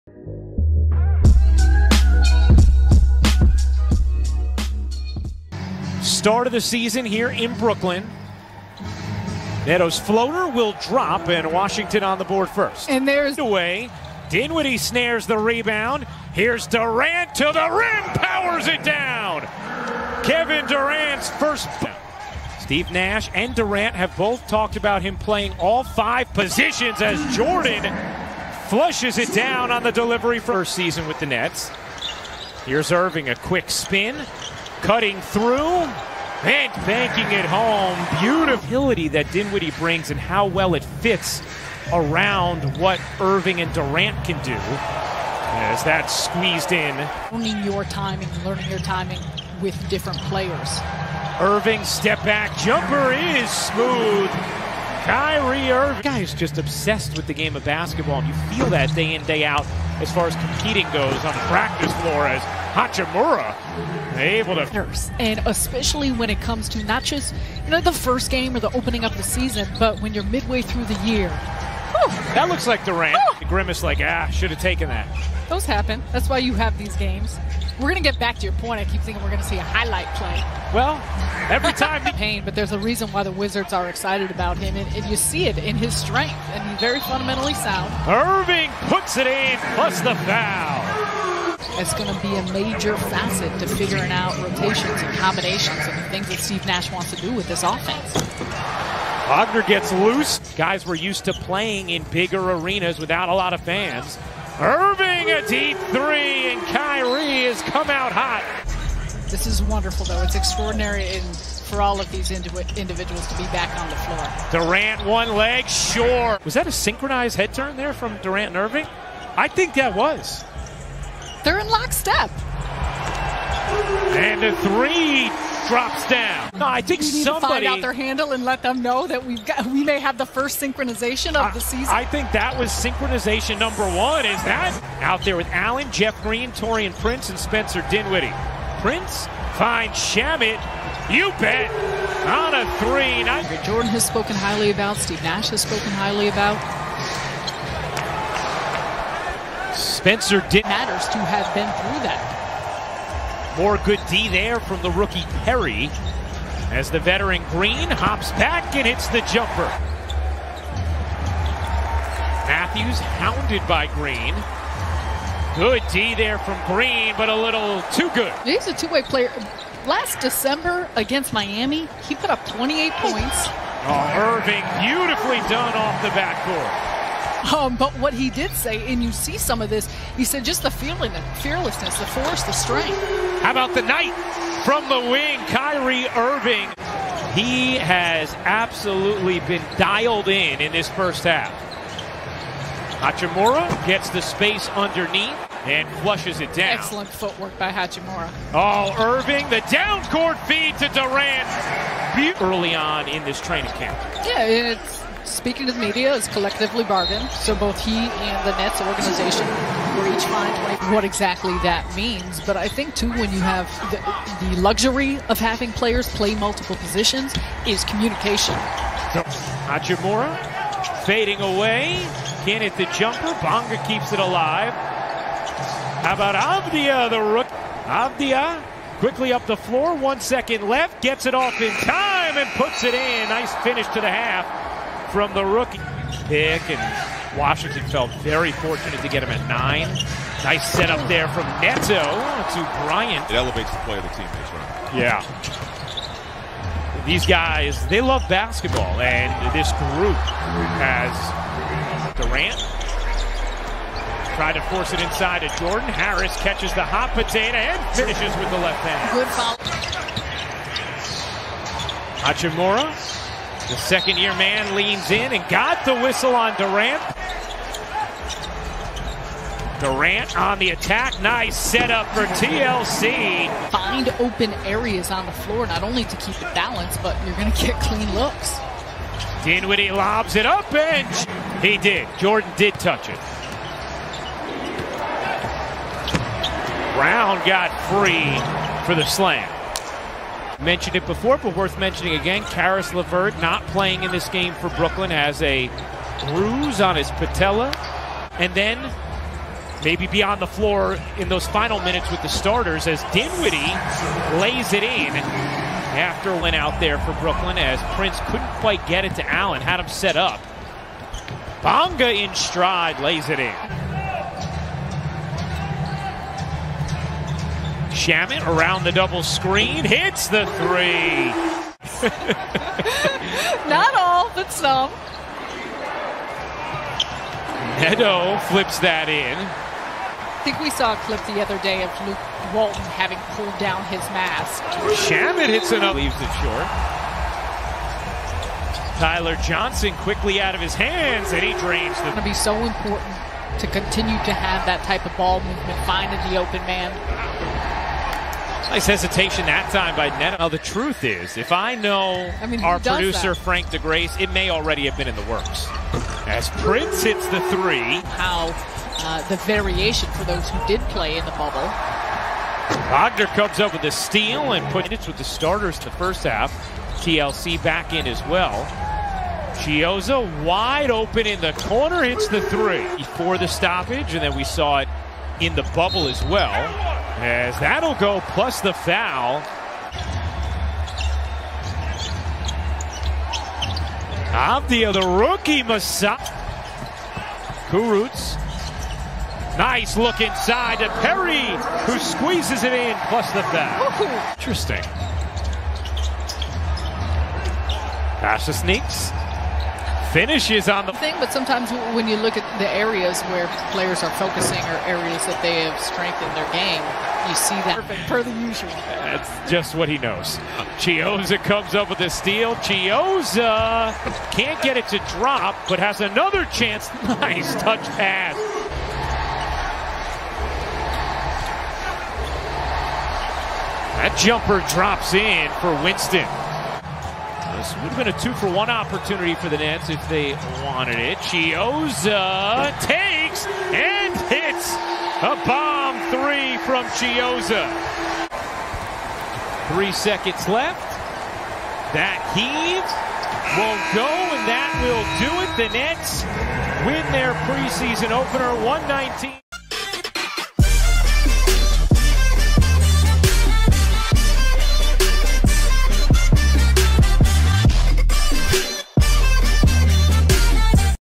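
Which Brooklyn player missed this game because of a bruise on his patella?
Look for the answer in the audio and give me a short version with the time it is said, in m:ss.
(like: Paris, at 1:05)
Caris LeVert, at 4:52.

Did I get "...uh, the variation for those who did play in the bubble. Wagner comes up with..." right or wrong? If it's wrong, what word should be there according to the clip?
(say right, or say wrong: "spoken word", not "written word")
right.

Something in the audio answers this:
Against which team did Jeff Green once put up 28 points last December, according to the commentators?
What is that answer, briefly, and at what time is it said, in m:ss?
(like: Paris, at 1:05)
Miami, at 2:51.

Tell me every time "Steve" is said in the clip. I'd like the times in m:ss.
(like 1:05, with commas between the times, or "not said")
0:22, 1:36, 2:24.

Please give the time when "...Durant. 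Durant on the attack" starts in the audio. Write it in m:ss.
4:26.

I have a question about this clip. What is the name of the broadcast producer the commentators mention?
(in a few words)
Frank DeGrace.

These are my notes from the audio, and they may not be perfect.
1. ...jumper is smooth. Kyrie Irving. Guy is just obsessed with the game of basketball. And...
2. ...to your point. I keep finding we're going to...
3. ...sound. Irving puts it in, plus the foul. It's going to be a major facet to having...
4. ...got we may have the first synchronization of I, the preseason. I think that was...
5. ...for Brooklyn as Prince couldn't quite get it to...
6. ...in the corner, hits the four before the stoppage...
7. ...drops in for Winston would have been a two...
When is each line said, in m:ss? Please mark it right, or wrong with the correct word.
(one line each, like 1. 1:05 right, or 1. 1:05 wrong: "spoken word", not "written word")
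1. 0:52 right
2. 1:18 wrong: "thinking", not "finding"
3. 1:27 wrong: "figuring", not "having"
4. 2:09 wrong: "season", not "preseason"
5. 5:06 right
6. 6:11 wrong: "three", not "four"
7. 7:04 right.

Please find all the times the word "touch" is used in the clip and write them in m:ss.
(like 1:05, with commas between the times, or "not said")
4:42, 6:57.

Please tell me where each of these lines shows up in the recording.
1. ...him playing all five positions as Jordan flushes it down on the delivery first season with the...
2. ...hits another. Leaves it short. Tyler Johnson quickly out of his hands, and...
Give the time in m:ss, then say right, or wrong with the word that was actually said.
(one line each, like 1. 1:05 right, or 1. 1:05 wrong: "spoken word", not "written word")
1. 0:25 right
2. 5:35 right.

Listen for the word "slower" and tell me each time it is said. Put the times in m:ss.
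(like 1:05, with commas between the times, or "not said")
not said.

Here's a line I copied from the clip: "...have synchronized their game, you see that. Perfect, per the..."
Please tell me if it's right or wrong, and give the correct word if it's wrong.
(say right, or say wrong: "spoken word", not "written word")
wrong: "strengthened", not "synchronized".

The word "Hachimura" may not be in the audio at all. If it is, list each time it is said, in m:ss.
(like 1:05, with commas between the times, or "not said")
1:02, 3:13, 3:17, 3:39, 4:22.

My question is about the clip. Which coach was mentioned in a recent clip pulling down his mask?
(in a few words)
Luke Walton.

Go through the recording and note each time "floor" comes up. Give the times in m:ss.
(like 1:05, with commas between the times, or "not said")
1:02, 1:53, 3:49, 4:35, 5:00.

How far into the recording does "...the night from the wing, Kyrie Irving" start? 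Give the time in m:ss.
3:03.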